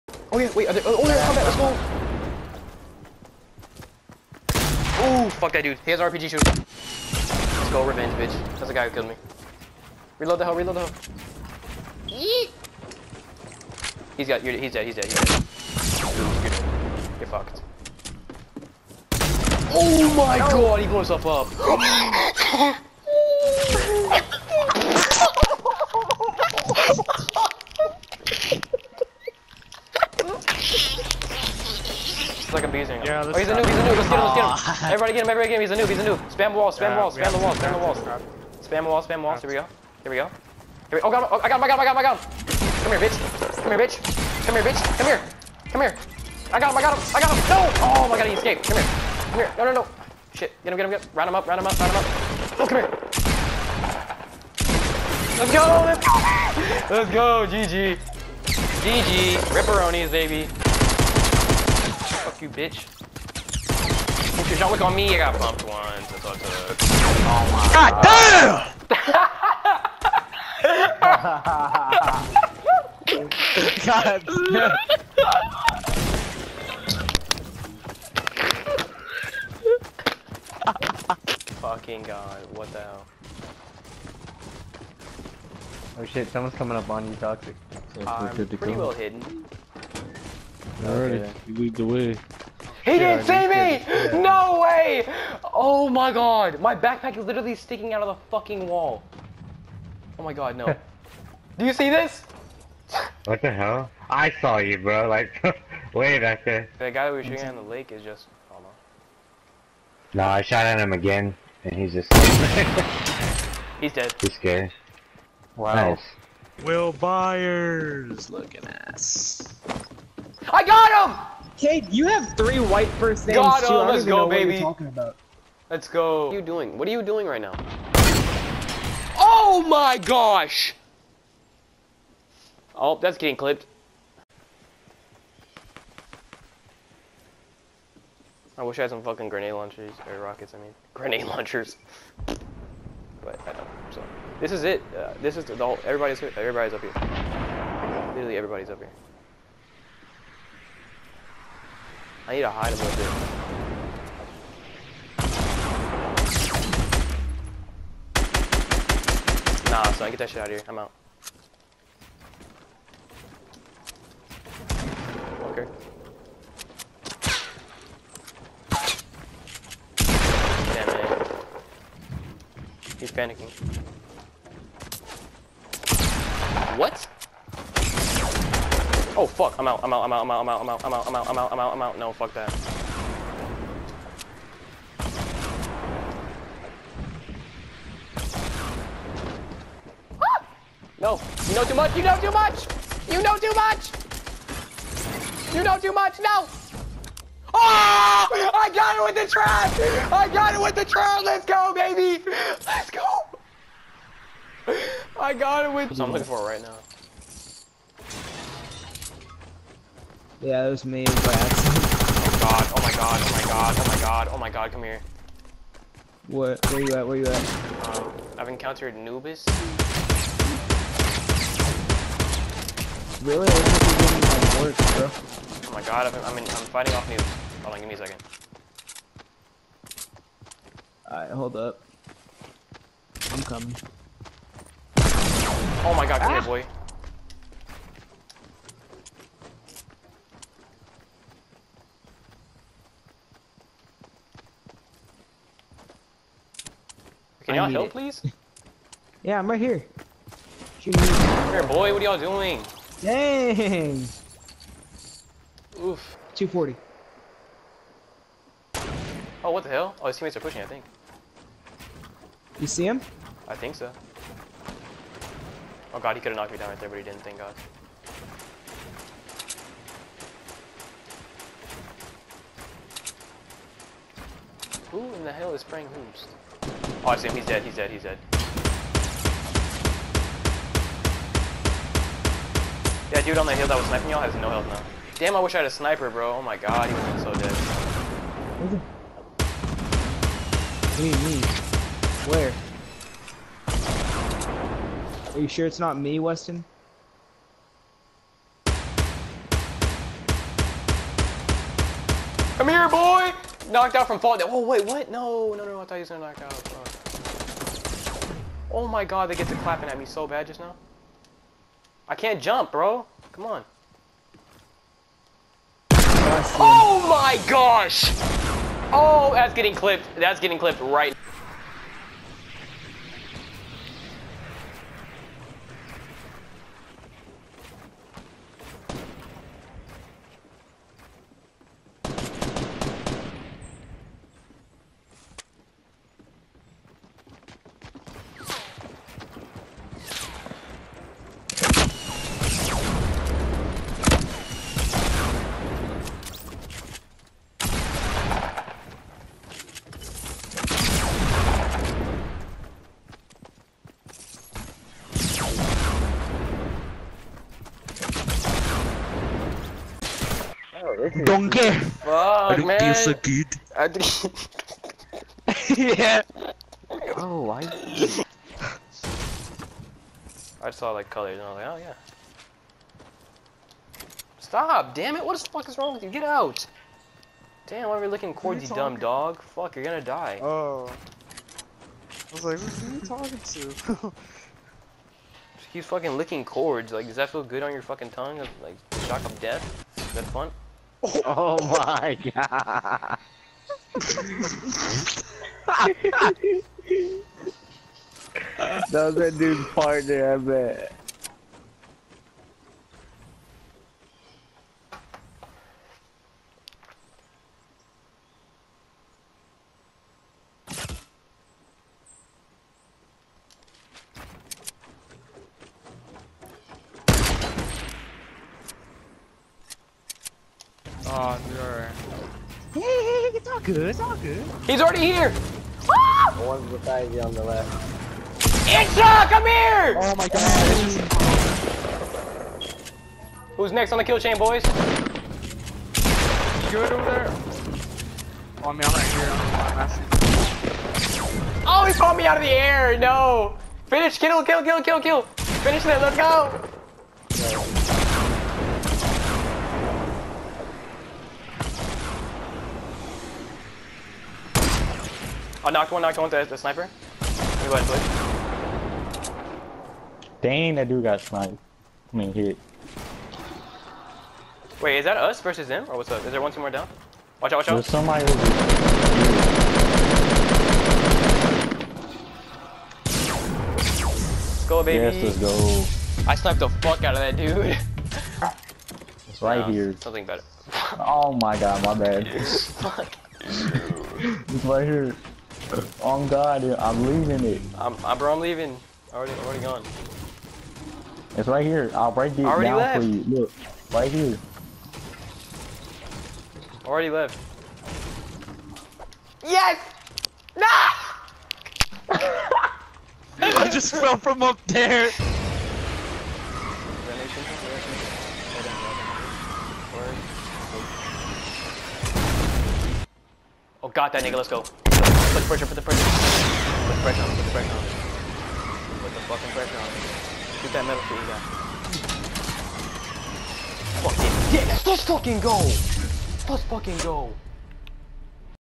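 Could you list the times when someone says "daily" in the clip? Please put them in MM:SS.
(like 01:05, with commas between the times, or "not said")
not said.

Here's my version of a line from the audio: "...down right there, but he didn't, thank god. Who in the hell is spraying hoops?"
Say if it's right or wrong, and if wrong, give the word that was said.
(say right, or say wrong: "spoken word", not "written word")
right.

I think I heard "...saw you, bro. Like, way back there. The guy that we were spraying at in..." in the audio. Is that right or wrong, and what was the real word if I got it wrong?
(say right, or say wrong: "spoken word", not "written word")
wrong: "shooting", not "spraying".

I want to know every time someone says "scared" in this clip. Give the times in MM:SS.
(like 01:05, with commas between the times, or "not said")
01:54.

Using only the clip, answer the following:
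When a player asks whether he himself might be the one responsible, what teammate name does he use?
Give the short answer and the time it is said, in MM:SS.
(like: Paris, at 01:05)
Weston, at 04:56.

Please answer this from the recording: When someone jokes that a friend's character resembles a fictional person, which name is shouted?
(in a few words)
Will Byers.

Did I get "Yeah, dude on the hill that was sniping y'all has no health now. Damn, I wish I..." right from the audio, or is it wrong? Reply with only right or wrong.
right.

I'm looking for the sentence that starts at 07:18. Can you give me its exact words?
Oh, I mean, I'm right here.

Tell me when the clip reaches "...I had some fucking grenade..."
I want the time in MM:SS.
02:18.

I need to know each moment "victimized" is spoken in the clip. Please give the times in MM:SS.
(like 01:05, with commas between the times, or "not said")
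not said.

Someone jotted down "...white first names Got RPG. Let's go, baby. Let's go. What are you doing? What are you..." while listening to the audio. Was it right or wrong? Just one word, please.
wrong.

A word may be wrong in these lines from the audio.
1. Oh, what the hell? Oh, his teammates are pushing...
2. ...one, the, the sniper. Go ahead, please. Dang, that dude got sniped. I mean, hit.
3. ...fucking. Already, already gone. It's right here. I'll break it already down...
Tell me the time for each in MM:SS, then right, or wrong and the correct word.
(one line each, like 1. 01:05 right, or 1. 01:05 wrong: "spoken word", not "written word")
1. 04:19 right
2. 07:36 right
3. 08:08 wrong: "leaving", not "fucking".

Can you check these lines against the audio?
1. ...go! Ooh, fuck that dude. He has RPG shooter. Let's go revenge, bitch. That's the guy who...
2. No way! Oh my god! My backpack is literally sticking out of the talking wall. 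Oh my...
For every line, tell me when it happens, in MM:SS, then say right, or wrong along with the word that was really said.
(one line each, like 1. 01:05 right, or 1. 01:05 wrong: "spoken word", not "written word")
1. 00:05 right
2. 01:34 wrong: "fucking", not "talking".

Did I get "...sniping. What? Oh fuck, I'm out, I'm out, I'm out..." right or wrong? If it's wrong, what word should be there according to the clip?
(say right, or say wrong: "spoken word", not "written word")
wrong: "panicking", not "sniping".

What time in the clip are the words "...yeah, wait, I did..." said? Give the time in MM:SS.
00:00.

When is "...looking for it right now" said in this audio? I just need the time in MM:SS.
03:26.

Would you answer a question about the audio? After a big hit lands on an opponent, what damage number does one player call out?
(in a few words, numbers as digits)
240.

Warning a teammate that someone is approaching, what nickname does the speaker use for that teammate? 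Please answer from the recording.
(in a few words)
Toxic.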